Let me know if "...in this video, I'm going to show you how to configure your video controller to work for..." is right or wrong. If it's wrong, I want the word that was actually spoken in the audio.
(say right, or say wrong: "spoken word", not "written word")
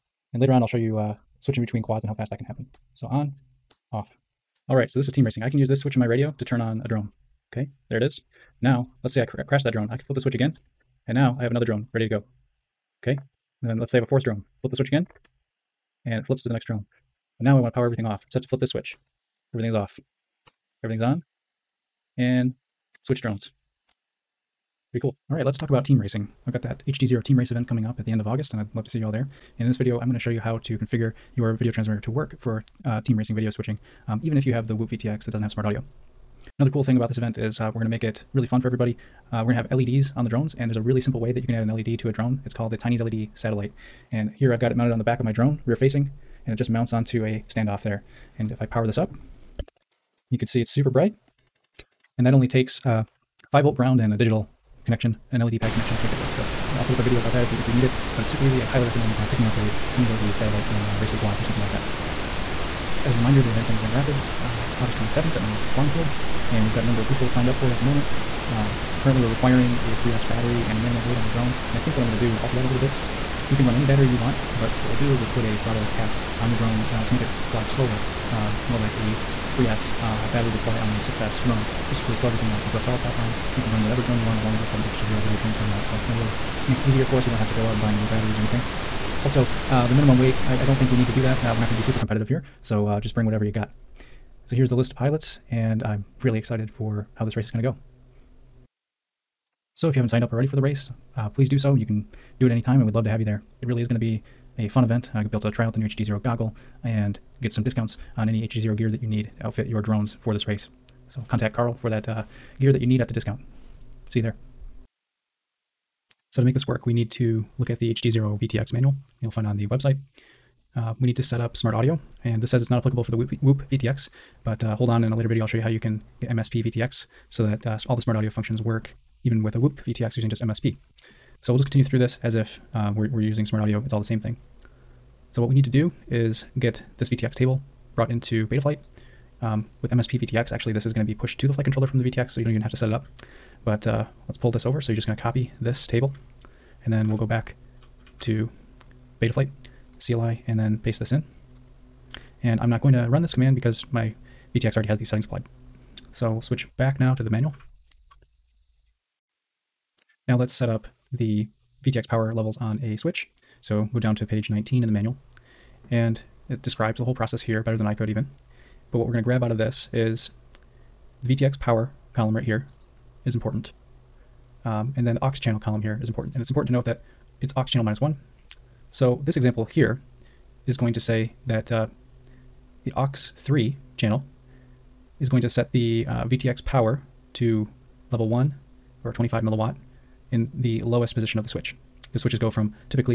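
wrong: "transmitter", not "controller".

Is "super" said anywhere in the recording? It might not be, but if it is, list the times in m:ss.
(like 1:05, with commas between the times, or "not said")
0:50, 0:58, 1:31.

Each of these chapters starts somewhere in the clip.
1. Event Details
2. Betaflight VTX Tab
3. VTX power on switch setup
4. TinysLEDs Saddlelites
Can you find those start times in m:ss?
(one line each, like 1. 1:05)
1. 1:01
2. 1:54
3. 2:38
4. 0:36.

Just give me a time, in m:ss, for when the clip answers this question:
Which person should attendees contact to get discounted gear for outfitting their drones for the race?
1:51.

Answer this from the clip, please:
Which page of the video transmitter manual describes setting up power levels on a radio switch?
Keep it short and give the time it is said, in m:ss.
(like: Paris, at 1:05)
19, at 2:44.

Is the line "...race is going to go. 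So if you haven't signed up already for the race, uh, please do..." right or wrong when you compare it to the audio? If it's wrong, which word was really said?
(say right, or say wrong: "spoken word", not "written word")
right.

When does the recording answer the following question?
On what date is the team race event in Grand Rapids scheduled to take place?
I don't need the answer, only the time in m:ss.
1:04.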